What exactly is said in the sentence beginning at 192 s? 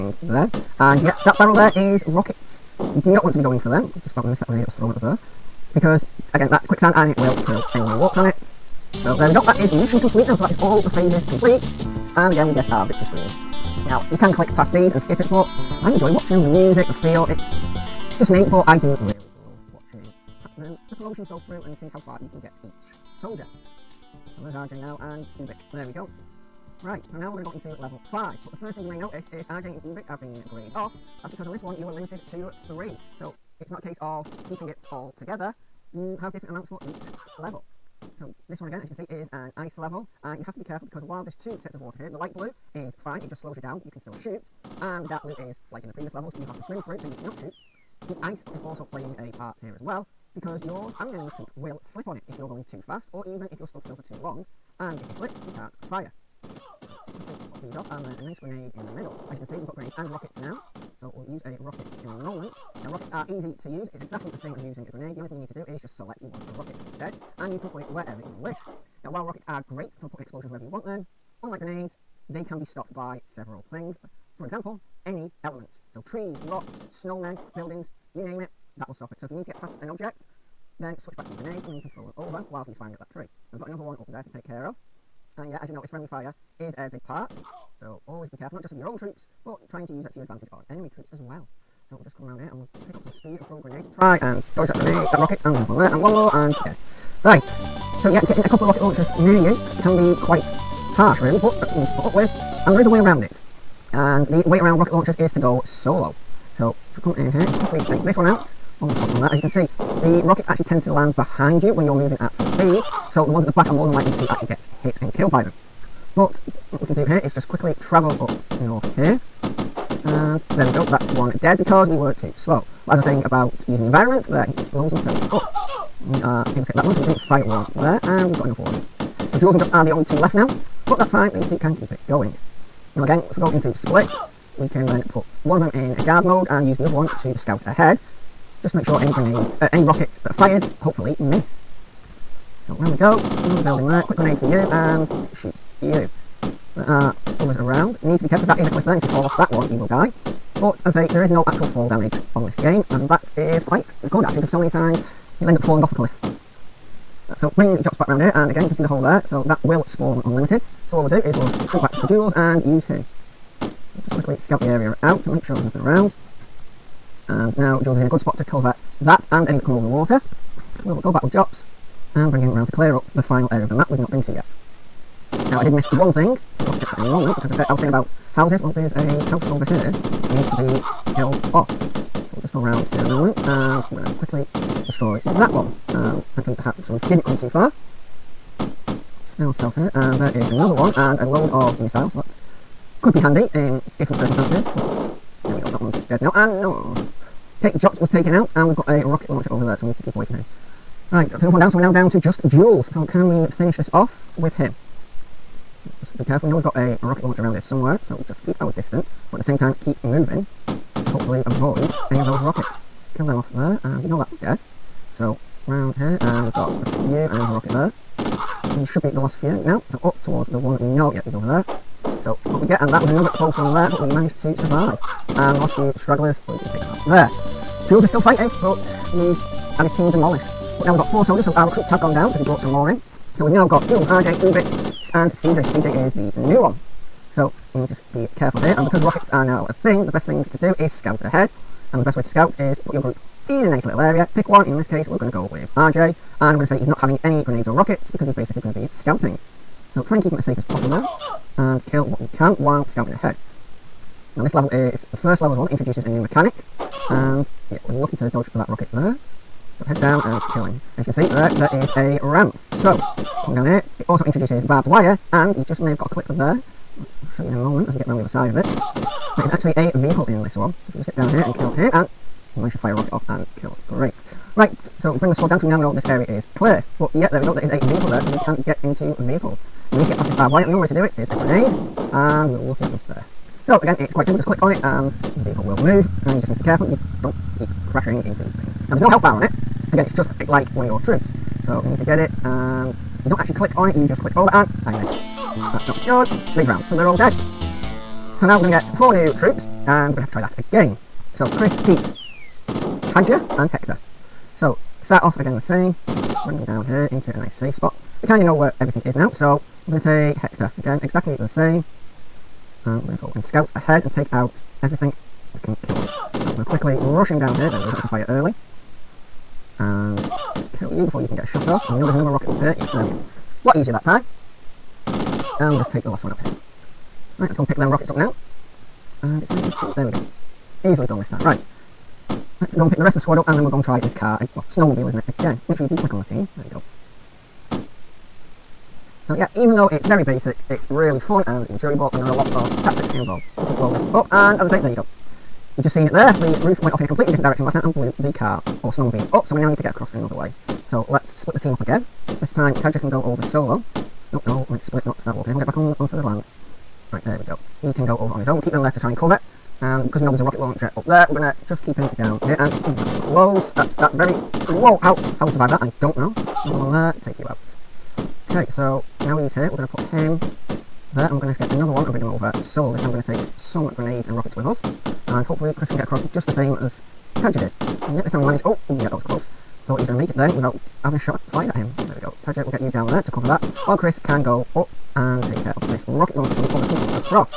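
that could be handy in different circumstances.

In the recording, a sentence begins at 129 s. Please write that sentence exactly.
So Jools and Jops are the only two left now, but that's fine, these two can keep it going.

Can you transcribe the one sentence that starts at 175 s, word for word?
Now I did miss one thing, I'll forget for any moment because I said I was saying about houses.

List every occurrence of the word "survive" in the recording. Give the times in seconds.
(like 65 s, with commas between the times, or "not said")
224 s, 365 s.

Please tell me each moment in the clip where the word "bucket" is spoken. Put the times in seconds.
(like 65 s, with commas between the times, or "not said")
not said.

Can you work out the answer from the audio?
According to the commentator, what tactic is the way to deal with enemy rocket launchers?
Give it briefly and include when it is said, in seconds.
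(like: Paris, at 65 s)
go solo, at 105 s.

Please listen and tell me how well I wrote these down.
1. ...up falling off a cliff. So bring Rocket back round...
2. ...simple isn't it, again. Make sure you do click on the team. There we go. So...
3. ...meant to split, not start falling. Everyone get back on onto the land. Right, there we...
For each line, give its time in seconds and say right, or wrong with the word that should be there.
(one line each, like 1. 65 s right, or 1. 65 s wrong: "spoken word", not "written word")
1. 155 s wrong: "Jops", not "Rocket"
2. 334 s wrong: "snowmobile", not "simple"
3. 354 s wrong: "walking", not "falling".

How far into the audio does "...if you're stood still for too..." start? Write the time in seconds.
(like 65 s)
53 s.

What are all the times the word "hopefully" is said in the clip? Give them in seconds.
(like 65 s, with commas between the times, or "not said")
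140 s, 211 s, 375 s.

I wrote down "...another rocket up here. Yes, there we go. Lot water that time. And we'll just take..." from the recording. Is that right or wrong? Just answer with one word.
wrong.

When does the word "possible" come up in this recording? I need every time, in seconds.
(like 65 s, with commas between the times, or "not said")
250 s.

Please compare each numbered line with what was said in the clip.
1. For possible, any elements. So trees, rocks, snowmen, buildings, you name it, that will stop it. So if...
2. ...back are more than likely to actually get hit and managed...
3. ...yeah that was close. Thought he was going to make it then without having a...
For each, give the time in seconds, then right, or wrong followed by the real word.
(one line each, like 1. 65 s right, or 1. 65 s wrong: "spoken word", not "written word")
1. 74 s wrong: "example", not "possible"
2. 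113 s wrong: "killed", not "managed"
3. 378 s right.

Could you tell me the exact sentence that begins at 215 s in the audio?
So brown hair, and we've got a few and a Rocket there.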